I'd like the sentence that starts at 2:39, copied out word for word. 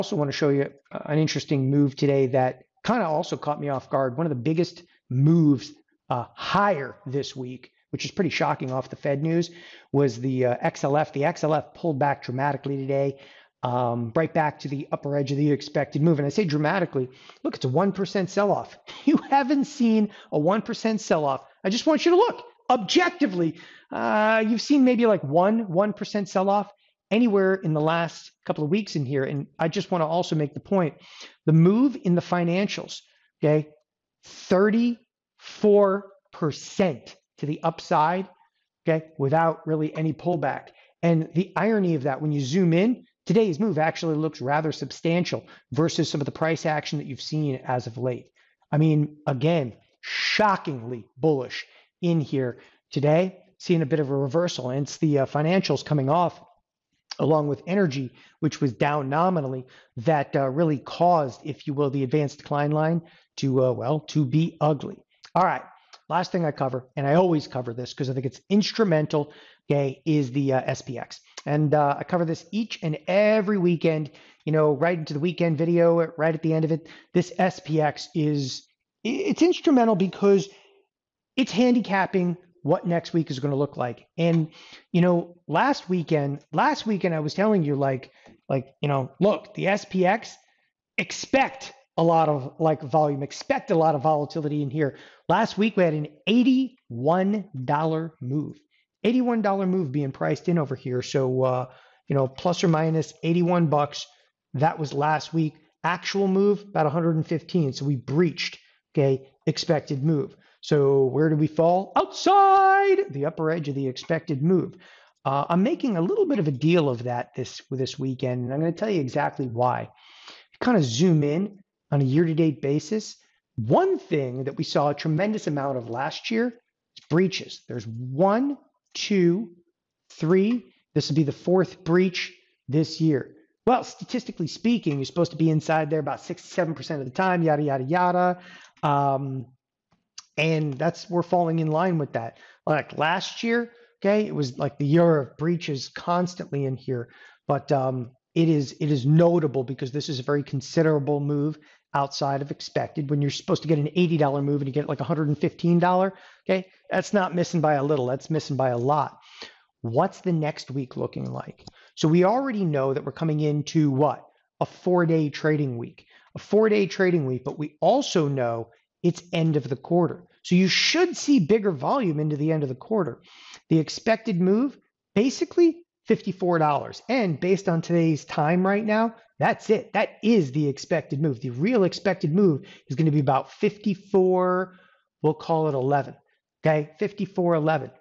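What's the next week looking like?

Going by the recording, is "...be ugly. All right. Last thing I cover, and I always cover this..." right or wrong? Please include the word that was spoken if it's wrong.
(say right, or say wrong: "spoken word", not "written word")
right.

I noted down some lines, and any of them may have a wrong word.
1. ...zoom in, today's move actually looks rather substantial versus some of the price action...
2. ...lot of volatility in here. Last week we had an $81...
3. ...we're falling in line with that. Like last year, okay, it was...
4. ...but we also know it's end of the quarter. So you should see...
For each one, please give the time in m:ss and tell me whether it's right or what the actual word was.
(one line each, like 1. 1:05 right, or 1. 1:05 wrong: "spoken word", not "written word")
1. 0:42 right
2. 1:33 right
3. 2:21 right
4. 2:47 right.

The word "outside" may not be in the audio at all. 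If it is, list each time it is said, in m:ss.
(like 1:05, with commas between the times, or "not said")
1:51, 2:31.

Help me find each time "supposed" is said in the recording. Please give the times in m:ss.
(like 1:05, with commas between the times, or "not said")
2:15, 2:33.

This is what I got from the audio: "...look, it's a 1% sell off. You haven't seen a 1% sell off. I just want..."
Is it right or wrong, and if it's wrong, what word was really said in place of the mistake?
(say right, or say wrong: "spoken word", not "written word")
right.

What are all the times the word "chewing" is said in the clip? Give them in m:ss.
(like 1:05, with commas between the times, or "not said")
not said.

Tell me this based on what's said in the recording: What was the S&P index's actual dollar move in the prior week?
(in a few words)
115.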